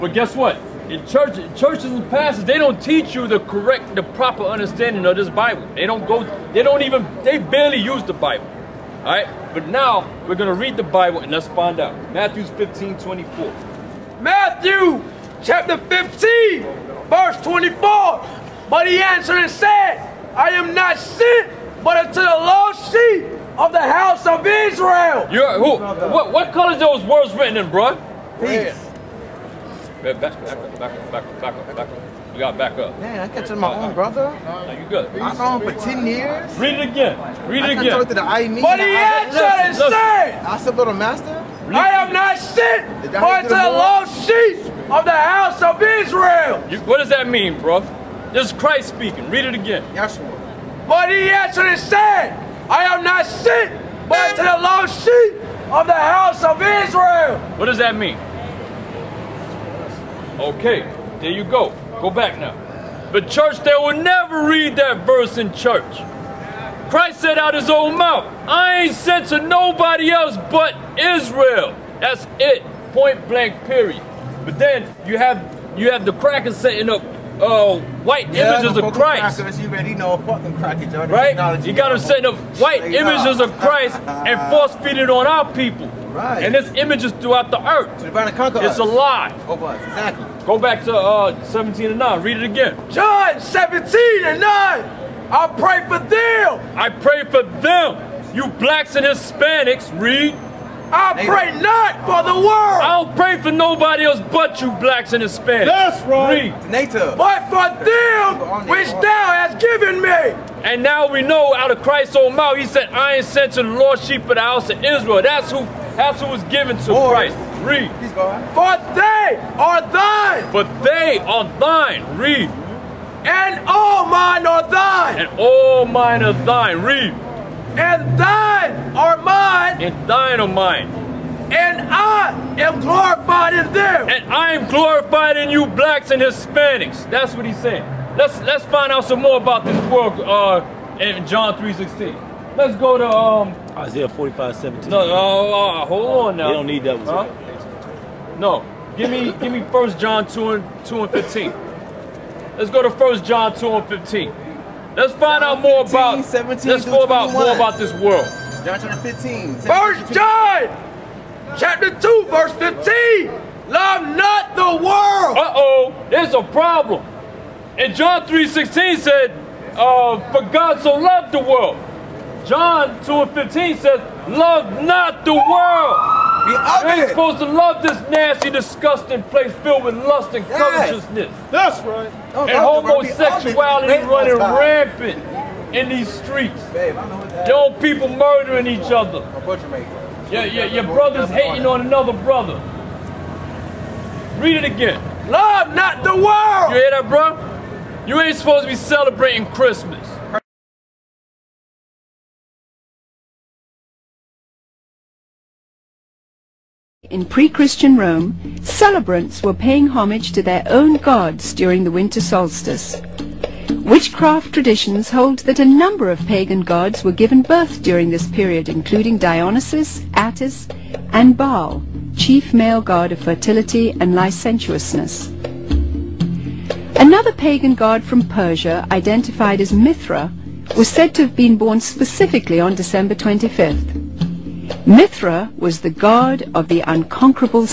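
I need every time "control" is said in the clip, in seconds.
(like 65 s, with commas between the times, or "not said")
not said.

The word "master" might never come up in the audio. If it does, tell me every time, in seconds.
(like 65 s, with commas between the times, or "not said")
40 s.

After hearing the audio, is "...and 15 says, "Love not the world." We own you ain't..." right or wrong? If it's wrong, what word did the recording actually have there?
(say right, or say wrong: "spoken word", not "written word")
right.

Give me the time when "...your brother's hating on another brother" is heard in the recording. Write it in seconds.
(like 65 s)
190 s.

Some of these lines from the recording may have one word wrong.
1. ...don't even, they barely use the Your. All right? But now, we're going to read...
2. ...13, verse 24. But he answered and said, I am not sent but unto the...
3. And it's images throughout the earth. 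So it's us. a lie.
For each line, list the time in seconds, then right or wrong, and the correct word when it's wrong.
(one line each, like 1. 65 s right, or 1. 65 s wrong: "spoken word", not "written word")
1. 6 s wrong: "Bible", not "Your"
2. 15 s wrong: "15", not "13"
3. 86 s right.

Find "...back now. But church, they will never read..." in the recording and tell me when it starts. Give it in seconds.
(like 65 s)
62 s.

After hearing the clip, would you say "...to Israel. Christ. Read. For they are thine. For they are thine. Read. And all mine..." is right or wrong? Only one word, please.
wrong.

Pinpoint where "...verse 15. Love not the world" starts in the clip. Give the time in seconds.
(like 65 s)
162 s.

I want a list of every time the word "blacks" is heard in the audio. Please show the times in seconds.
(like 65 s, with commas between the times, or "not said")
98 s, 104 s, 135 s.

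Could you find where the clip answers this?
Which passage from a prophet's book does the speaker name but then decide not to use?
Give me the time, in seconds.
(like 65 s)
143 s.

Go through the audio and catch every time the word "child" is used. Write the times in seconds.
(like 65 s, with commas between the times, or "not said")
not said.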